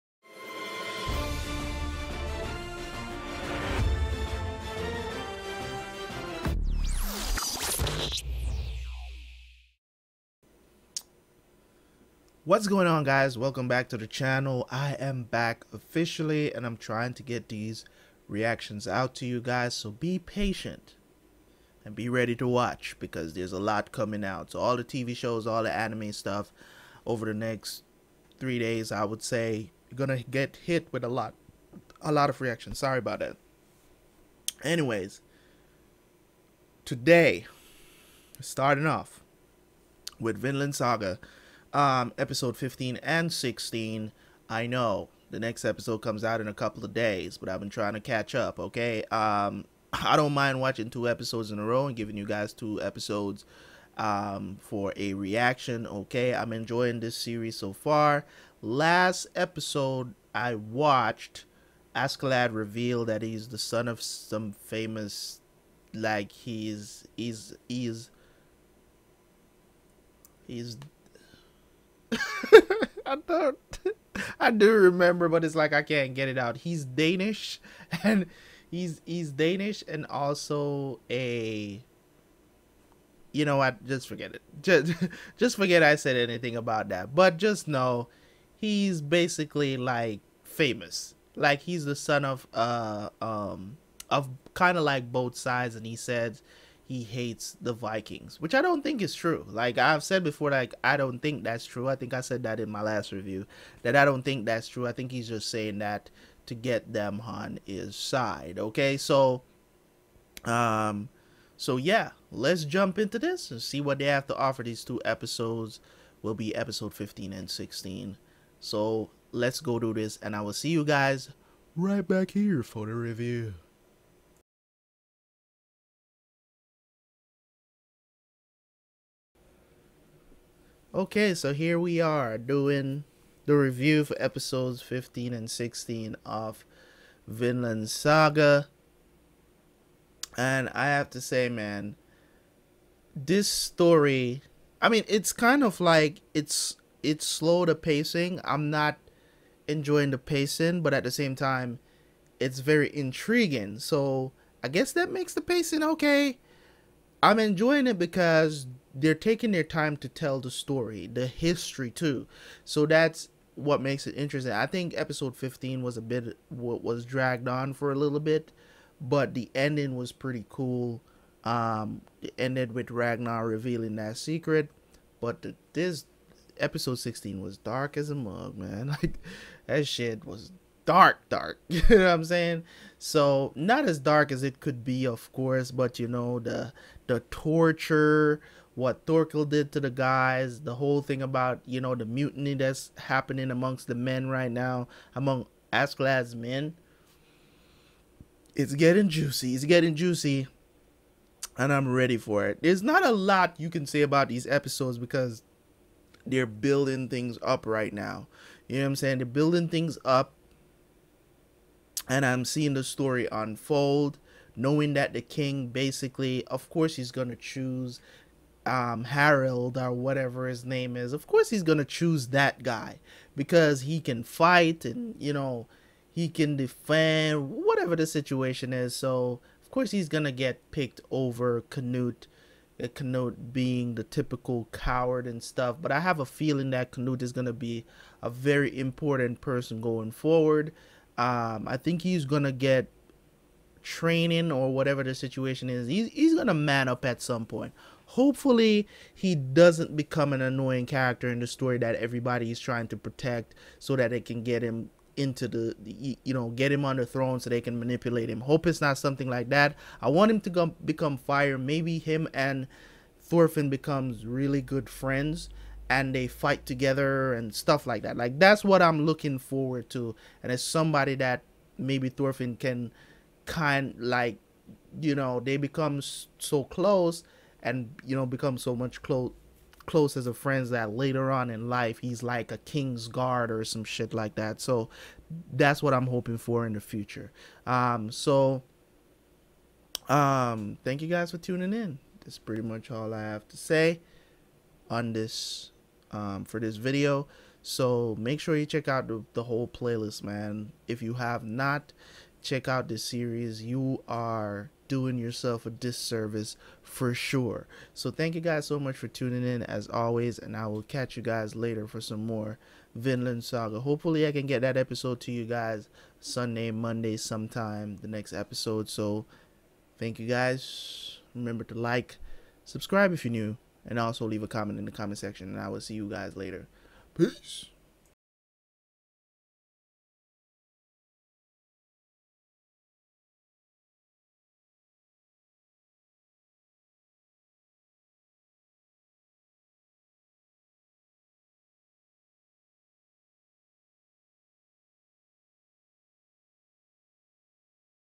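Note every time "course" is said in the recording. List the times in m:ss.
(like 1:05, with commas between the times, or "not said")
3:05, 3:36, 3:41, 3:49.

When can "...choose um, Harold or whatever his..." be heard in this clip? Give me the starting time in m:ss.
3:37.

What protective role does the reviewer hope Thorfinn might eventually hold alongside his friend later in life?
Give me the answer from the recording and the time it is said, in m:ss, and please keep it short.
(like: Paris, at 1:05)
king's guard, at 4:42.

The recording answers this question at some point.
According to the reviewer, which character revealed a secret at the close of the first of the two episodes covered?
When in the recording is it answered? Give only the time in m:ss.
2:52.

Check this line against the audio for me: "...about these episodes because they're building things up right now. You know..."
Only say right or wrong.
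right.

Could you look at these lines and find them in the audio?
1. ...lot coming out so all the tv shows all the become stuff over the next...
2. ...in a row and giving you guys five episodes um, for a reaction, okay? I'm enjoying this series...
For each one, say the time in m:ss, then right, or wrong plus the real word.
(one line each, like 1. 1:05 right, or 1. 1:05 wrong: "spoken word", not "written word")
1. 0:23 wrong: "anime", not "become"
2. 0:51 wrong: "two", not "five".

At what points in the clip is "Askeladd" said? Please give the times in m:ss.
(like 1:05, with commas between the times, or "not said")
1:01, 3:15.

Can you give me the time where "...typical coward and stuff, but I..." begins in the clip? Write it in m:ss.
3:54.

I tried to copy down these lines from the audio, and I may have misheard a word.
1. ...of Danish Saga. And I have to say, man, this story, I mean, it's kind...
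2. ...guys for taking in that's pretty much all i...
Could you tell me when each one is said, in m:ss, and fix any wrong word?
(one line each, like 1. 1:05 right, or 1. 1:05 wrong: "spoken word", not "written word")
1. 2:16 wrong: "Vinland", not "Danish"
2. 4:51 wrong: "tuning", not "taking".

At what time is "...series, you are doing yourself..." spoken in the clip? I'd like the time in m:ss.
5:03.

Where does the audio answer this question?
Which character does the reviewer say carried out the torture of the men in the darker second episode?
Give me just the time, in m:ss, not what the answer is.
3:09.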